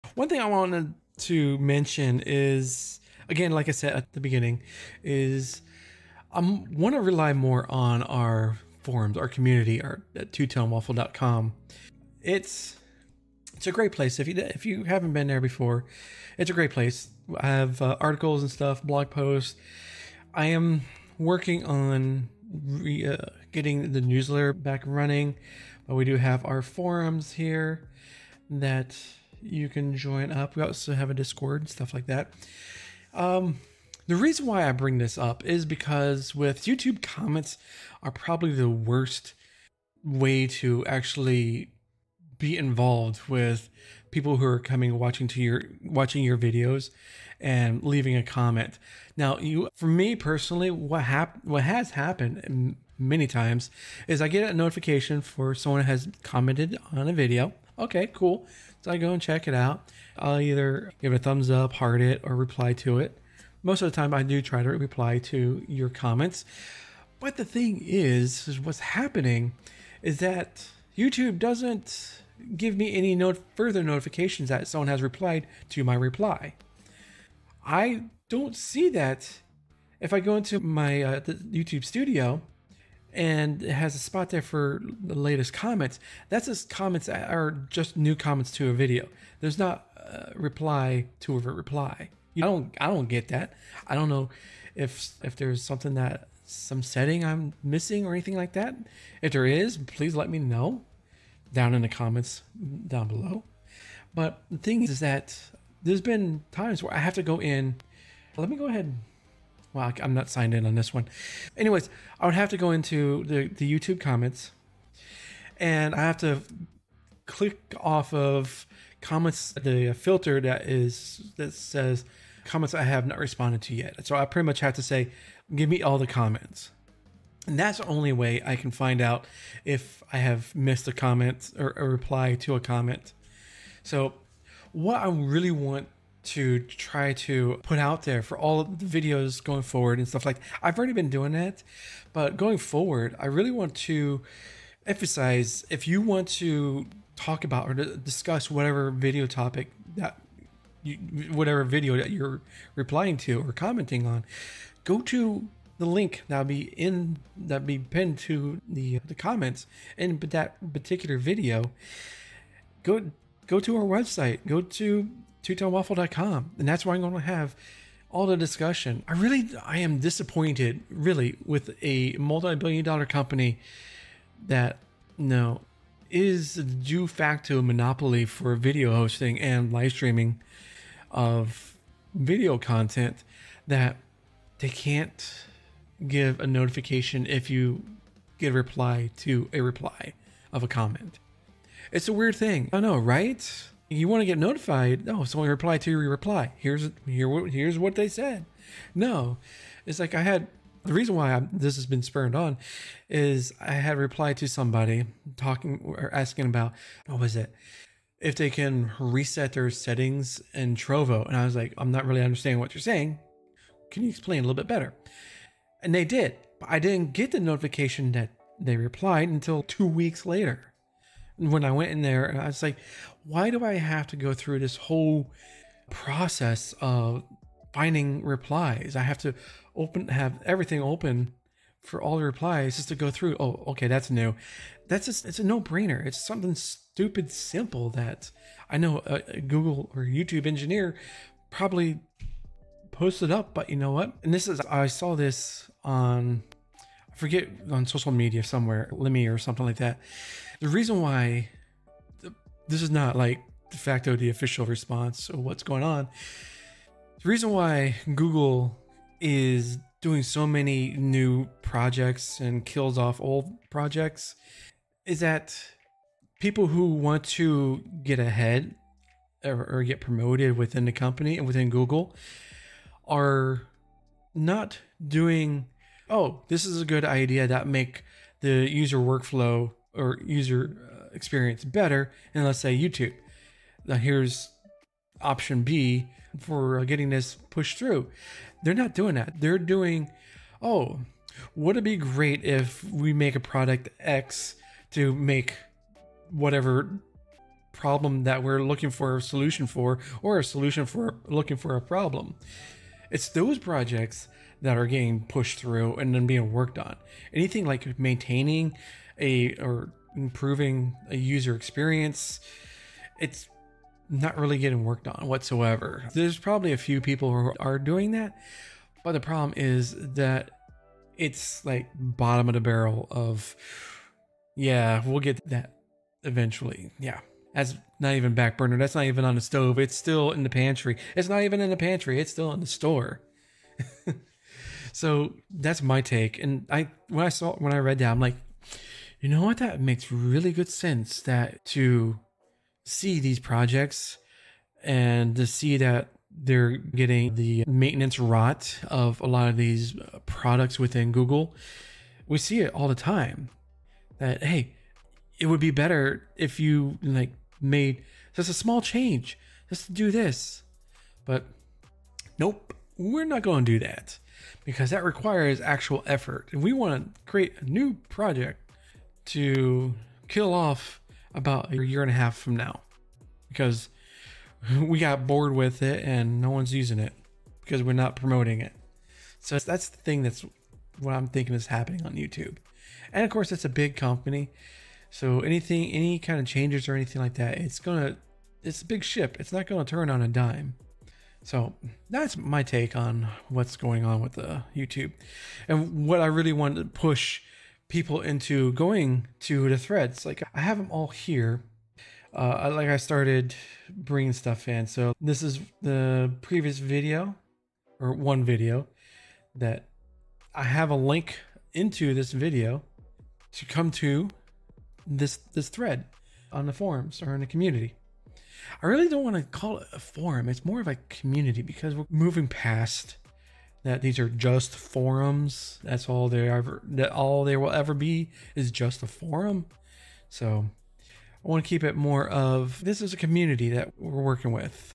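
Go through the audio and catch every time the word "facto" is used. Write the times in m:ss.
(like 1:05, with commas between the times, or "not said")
2:57, 4:13.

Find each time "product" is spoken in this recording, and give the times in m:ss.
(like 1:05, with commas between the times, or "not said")
4:53, 5:50.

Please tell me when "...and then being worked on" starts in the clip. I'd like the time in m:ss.
5:05.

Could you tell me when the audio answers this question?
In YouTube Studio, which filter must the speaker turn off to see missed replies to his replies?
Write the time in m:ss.
2:02.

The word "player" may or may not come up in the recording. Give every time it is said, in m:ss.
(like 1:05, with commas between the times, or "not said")
not said.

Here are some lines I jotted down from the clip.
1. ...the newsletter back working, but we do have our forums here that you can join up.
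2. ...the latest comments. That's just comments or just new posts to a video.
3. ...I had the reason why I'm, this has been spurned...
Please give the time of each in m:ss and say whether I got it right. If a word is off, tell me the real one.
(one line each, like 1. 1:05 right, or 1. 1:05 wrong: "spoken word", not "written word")
1. 0:23 wrong: "running", not "working"
2. 1:25 wrong: "comments", not "posts"
3. 3:20 right.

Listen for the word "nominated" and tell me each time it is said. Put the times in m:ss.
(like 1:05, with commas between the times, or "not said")
not said.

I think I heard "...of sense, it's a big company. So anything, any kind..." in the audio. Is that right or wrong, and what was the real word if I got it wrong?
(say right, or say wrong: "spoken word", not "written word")
wrong: "course", not "sense".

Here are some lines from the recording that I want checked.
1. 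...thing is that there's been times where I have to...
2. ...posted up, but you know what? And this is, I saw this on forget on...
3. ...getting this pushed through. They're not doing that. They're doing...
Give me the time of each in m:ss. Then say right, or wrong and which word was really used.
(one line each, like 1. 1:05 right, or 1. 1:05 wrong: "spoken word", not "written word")
1. 1:44 right
2. 4:02 right
3. 4:46 right.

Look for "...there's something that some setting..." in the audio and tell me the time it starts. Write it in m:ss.
1:35.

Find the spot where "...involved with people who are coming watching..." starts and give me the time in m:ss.
0:42.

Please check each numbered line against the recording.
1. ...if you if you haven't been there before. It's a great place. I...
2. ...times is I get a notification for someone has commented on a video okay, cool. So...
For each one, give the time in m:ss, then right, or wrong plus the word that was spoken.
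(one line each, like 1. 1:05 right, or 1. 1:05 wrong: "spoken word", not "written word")
1. 0:14 right
2. 0:53 right.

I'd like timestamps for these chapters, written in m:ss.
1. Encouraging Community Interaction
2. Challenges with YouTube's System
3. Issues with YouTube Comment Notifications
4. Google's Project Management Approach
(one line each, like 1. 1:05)
1. 6:31
2. 2:48
3. 0:33
4. 4:17.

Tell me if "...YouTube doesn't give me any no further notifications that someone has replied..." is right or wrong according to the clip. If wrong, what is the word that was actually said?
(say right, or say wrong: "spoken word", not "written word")
right.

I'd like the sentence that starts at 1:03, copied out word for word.
Most of the time, I do try to reply to your comments.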